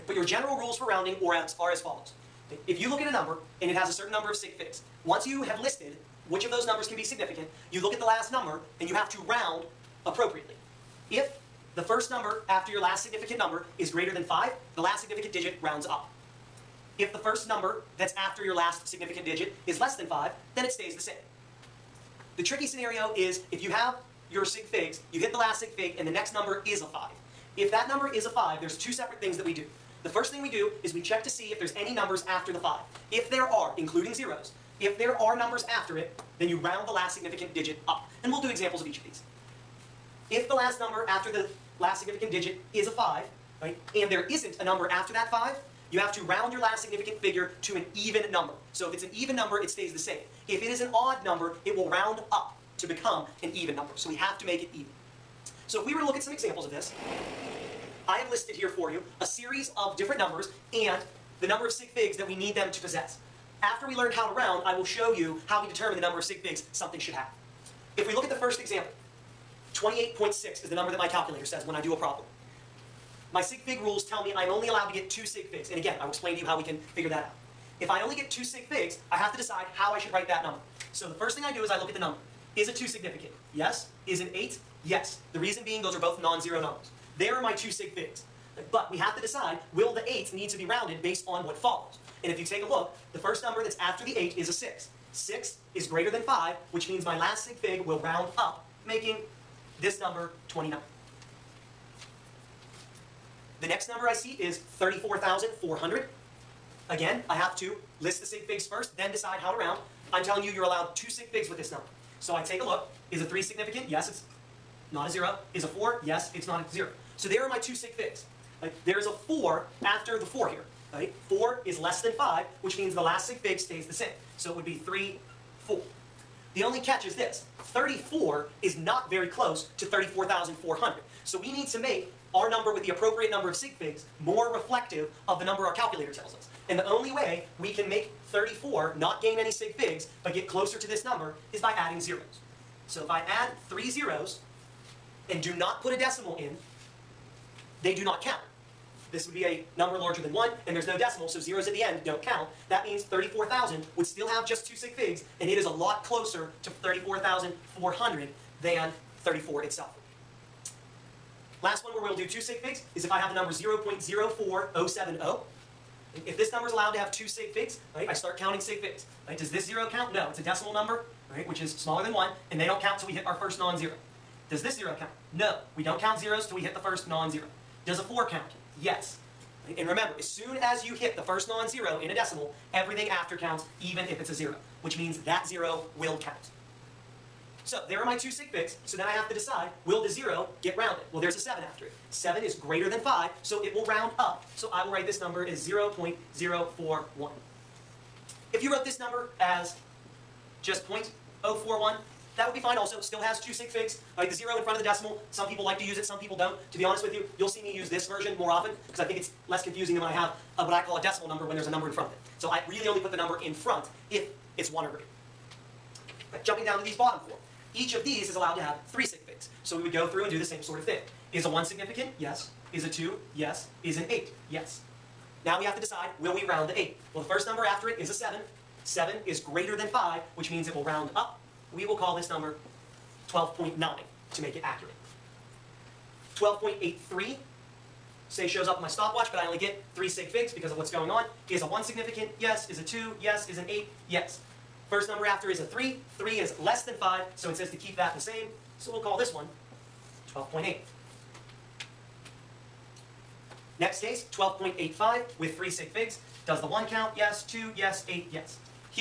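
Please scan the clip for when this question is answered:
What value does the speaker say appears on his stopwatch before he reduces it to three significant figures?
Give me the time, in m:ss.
3:56.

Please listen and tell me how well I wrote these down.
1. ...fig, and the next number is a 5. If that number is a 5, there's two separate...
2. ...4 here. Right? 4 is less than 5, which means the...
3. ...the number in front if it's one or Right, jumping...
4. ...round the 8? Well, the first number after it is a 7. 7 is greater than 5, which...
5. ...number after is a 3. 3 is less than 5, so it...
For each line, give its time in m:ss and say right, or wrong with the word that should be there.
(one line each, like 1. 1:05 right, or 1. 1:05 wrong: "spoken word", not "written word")
1. 0:25 right
2. 2:00 right
3. 3:33 right
4. 3:46 right
5. 4:05 right.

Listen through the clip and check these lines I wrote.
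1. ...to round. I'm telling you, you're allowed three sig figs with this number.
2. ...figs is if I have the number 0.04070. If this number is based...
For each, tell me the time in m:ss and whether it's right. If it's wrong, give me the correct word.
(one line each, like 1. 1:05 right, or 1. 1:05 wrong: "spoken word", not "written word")
1. 1:49 wrong: "two", not "three"
2. 2:42 wrong: "allowed", not "based".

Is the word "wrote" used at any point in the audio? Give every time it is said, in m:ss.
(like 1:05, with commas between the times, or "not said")
3:18.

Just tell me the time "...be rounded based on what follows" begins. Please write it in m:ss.
1:30.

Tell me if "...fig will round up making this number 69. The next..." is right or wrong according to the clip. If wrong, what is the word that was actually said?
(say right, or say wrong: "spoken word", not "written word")
wrong: "29", not "69".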